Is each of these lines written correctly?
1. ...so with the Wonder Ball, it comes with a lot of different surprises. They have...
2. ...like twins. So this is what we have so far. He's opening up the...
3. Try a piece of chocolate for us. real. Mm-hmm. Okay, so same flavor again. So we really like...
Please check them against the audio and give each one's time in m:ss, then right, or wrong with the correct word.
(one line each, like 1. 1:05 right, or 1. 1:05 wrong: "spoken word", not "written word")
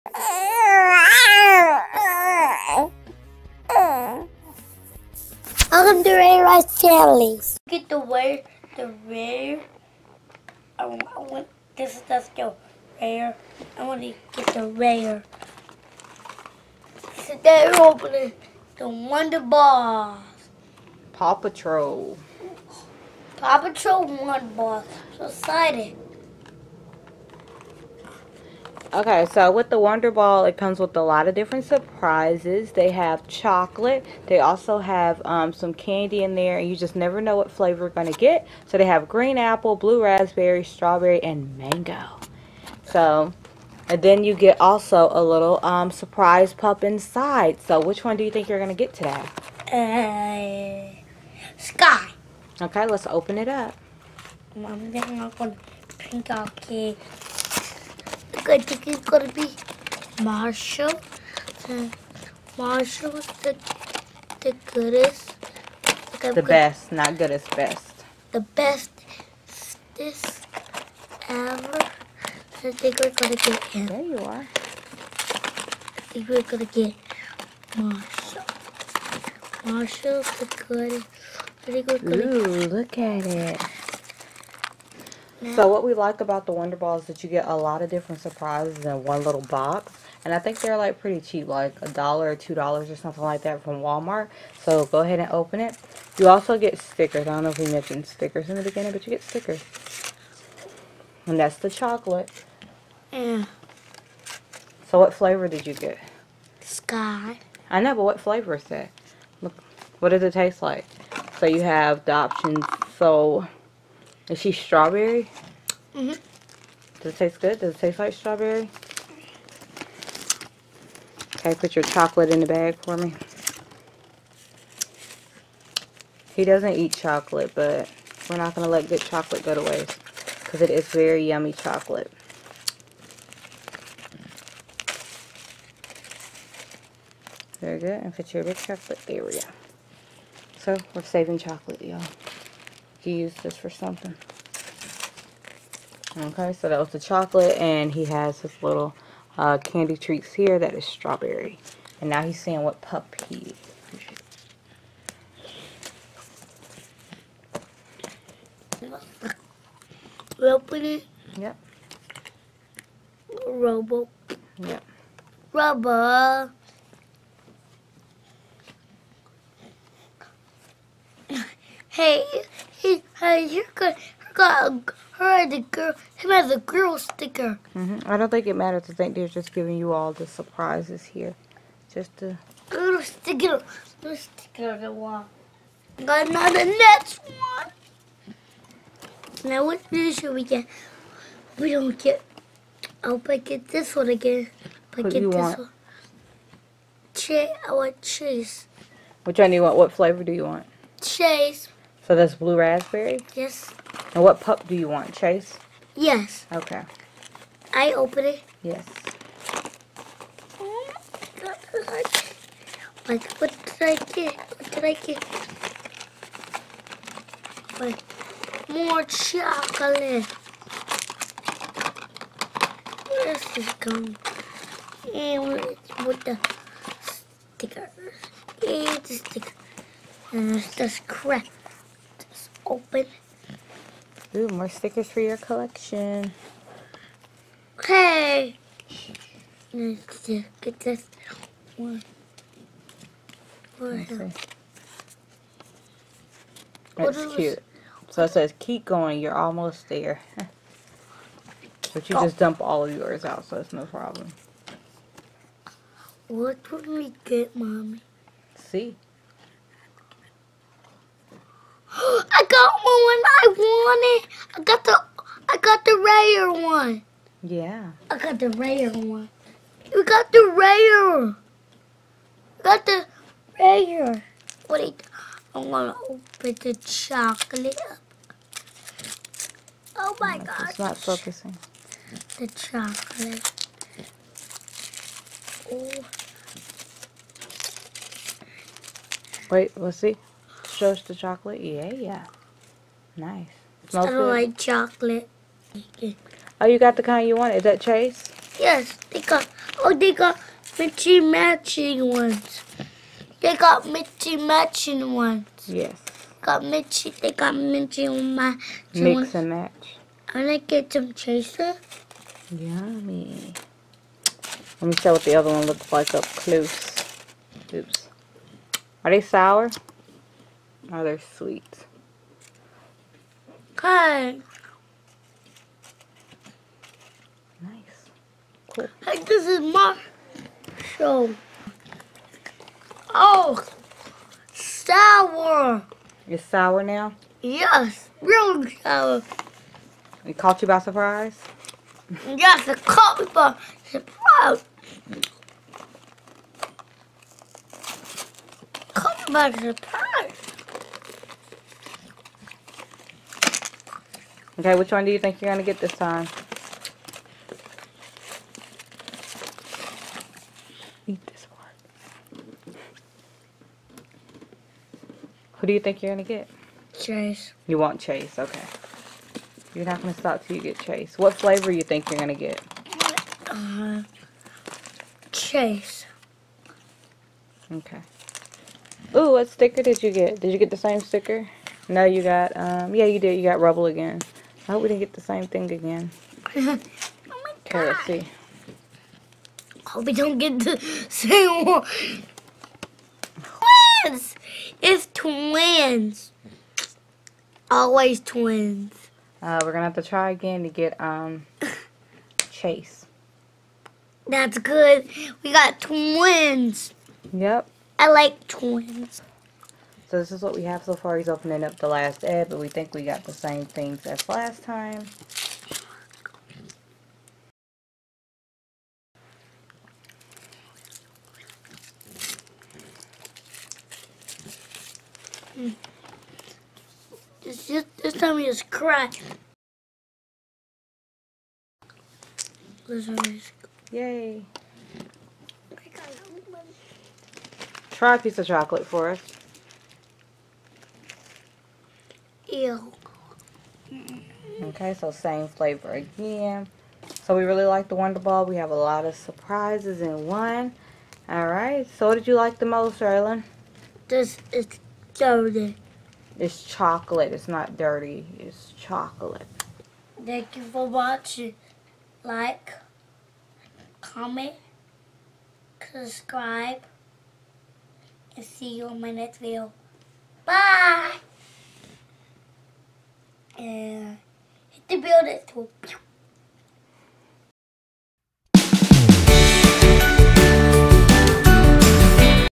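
1. 0:29 right
2. 6:48 right
3. 7:17 right.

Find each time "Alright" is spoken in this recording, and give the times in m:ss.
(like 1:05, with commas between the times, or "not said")
7:31.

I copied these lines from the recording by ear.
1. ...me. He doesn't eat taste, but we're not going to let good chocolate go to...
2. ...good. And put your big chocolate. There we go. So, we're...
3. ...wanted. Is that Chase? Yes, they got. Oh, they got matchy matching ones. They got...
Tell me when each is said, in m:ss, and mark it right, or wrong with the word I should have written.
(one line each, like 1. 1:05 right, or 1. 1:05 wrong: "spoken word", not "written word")
1. 2:02 wrong: "chocolate", not "taste"
2. 2:17 right
3. 4:57 right.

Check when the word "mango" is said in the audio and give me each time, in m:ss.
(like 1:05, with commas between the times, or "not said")
0:41.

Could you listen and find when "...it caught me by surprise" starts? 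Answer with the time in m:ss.
5:42.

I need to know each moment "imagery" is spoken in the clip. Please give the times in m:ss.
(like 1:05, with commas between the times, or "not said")
not said.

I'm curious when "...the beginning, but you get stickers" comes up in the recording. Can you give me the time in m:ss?
1:38.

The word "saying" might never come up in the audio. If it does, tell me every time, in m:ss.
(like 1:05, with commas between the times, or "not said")
2:32.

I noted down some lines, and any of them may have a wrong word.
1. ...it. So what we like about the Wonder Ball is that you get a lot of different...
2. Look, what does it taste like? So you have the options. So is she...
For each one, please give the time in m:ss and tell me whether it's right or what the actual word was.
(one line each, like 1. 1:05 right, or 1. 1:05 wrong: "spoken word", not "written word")
1. 1:23 right
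2. 1:49 right.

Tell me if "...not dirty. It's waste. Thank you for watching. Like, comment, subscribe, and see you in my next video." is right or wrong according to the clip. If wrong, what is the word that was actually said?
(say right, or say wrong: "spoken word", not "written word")
wrong: "chocolate", not "waste".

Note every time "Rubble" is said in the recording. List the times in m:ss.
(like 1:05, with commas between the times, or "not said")
2:45, 6:23.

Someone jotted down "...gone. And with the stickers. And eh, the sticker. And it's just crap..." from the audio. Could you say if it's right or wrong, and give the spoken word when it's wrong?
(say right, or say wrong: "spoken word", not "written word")
right.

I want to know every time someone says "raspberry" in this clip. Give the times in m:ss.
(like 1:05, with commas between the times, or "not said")
0:40, 3:22.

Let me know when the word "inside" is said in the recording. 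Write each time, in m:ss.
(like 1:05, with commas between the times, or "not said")
0:46.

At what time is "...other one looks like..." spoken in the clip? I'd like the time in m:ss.
5:15.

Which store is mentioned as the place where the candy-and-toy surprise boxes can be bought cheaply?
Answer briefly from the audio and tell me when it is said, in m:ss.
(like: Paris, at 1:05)
Walmart, at 1:33.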